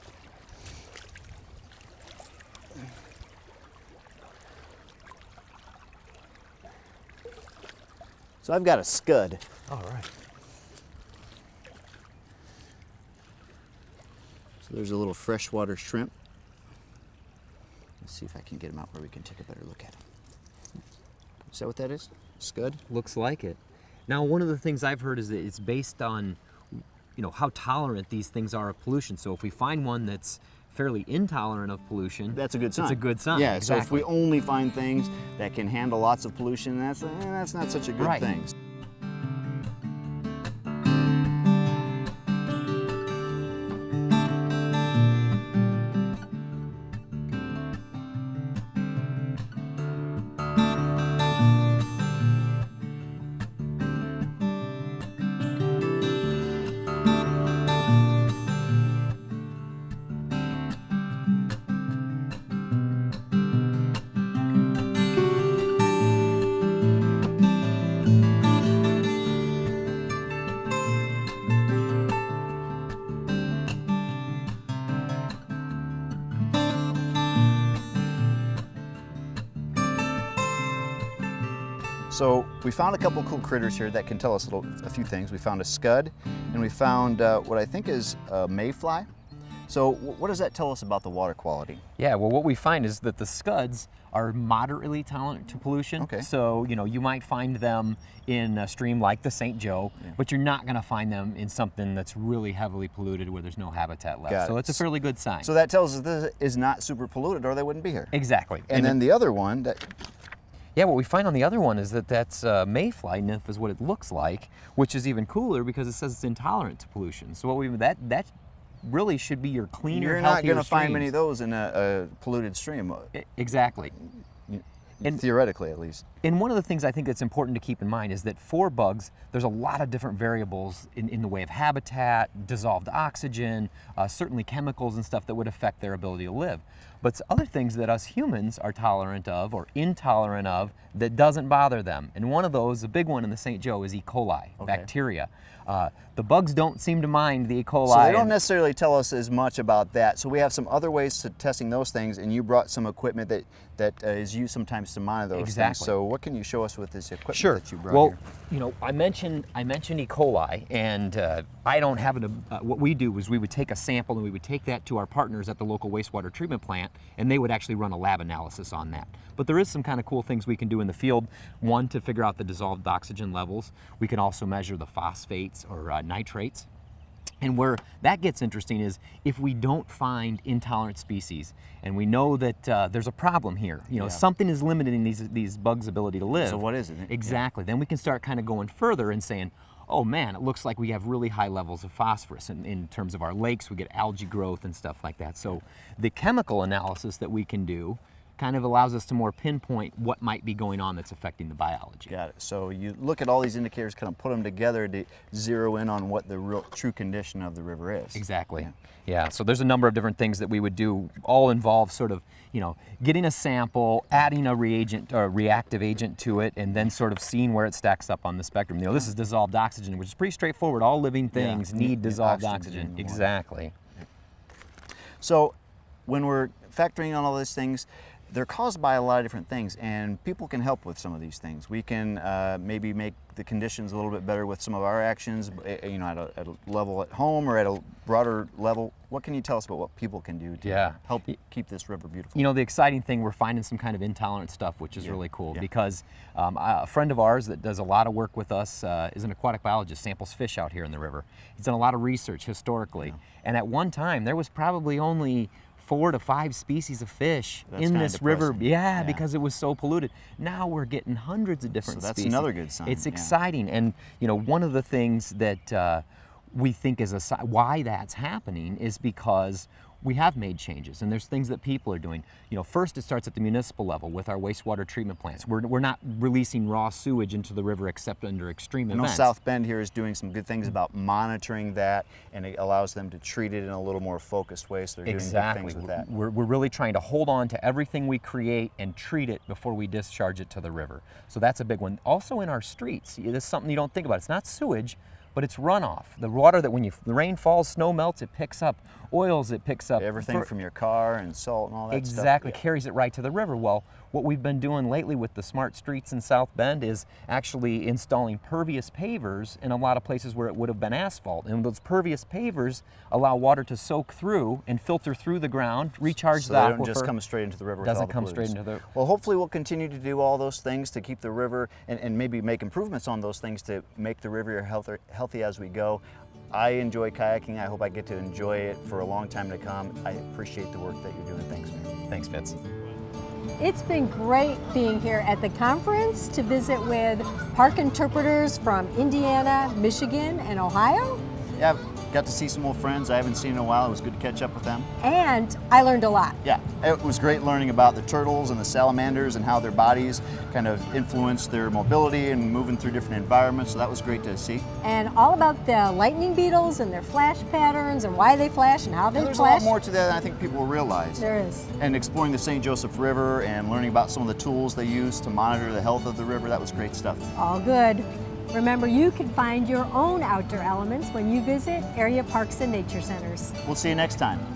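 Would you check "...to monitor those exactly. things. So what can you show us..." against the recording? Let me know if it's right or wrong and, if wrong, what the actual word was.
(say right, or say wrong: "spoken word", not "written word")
right.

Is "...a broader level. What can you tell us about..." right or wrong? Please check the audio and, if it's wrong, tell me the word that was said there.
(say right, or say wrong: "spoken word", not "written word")
right.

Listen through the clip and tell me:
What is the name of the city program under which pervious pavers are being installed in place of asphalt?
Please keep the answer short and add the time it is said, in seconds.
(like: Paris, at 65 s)
Smart streets, at 305 s.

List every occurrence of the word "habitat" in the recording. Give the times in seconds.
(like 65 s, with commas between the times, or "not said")
103 s, 131 s.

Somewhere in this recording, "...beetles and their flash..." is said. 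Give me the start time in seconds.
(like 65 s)
356 s.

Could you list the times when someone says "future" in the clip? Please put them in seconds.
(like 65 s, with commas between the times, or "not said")
not said.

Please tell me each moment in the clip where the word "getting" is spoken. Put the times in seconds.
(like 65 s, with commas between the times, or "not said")
213 s, 260 s.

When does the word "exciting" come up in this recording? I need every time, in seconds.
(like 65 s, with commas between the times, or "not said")
242 s, 263 s.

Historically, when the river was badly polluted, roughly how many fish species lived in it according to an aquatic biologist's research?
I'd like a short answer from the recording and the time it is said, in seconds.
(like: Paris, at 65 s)
4 to 5, at 255 s.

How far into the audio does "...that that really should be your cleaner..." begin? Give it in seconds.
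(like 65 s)
117 s.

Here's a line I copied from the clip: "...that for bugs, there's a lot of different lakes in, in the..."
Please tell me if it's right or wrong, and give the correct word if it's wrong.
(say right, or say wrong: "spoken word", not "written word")
wrong: "variables", not "lakes".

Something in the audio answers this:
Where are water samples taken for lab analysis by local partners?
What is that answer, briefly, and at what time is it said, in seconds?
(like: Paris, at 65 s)
Wastewater treatment plant, at 165 s.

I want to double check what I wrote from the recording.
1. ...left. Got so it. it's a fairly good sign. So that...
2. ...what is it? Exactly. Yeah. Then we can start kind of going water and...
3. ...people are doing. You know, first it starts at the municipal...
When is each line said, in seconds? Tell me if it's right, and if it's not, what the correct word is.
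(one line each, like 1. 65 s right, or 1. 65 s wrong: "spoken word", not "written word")
1. 104 s right
2. 186 s wrong: "further", not "water"
3. 271 s right.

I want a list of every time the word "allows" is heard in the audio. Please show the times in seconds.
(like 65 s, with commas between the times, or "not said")
198 s, 282 s, 313 s.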